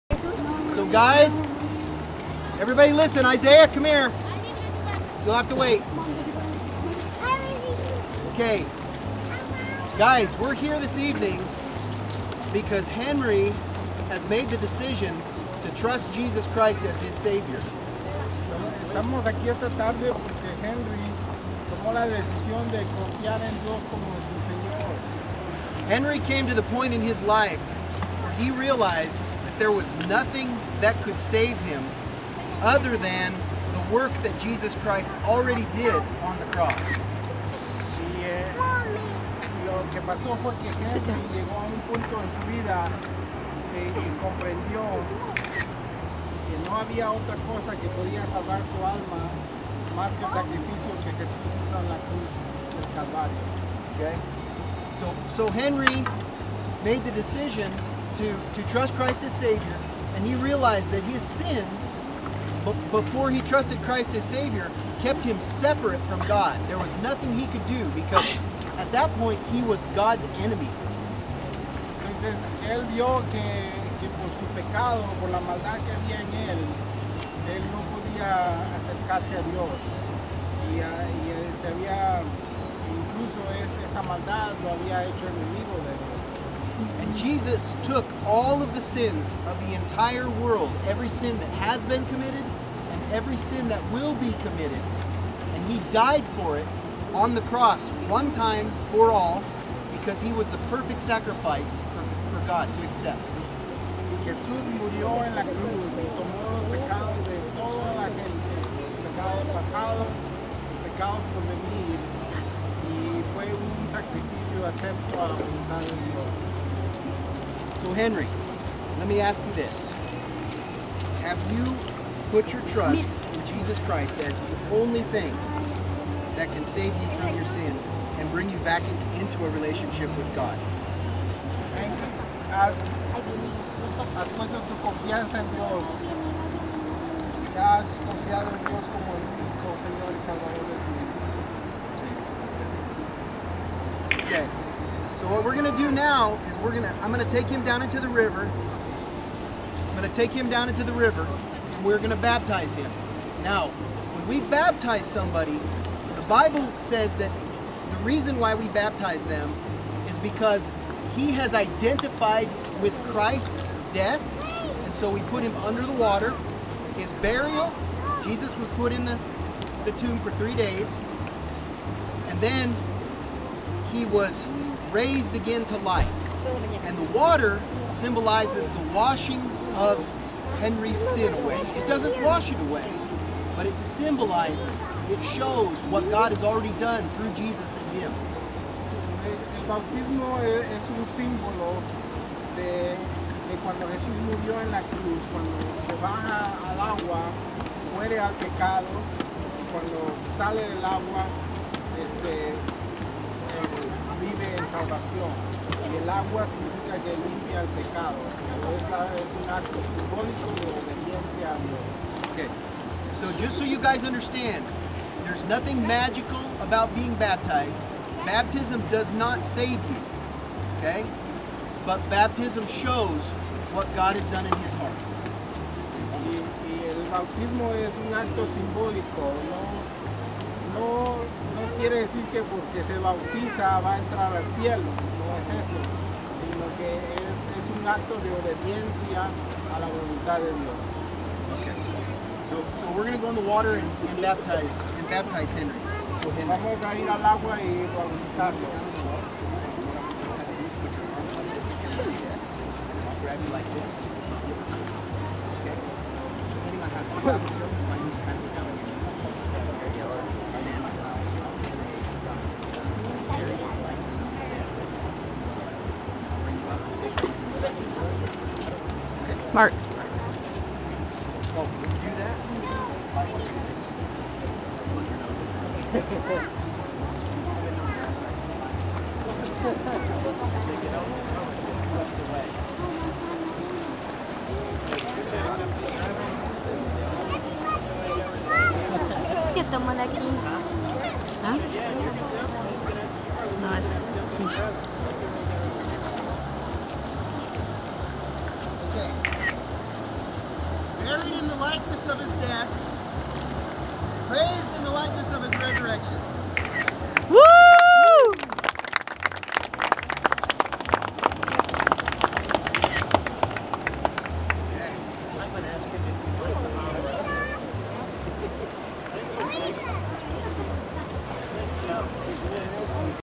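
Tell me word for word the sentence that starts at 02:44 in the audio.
And so we put him under the water.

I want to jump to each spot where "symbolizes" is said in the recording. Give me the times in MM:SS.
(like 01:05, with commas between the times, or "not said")
02:57, 03:03.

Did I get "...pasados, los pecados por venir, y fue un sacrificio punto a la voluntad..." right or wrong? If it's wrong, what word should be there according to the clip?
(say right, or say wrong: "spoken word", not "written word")
wrong: "acepto", not "punto".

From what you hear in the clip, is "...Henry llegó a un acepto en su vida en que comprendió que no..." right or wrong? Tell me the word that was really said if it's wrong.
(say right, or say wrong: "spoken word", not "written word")
wrong: "punto", not "acepto".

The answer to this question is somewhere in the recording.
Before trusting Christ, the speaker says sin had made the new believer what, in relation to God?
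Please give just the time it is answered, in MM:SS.
01:09.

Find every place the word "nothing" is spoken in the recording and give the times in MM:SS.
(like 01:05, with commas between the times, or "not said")
00:30, 01:07, 03:35.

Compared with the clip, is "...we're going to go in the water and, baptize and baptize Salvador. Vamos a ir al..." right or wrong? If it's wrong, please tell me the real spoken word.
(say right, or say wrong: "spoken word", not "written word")
wrong: "Henry", not "Salvador".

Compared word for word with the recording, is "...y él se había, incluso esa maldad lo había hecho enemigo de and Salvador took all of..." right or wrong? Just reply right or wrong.
wrong.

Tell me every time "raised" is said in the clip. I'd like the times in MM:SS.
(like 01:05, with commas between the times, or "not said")
02:54.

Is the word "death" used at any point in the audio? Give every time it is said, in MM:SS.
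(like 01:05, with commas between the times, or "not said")
02:43, 05:02.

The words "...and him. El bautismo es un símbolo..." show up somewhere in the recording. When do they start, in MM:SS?
03:07.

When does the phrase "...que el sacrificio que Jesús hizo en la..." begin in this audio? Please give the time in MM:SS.
00:50.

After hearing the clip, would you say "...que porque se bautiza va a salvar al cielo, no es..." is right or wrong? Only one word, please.
wrong.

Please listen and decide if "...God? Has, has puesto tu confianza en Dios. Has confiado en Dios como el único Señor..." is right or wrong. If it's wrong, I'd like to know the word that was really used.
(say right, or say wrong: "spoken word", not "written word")
right.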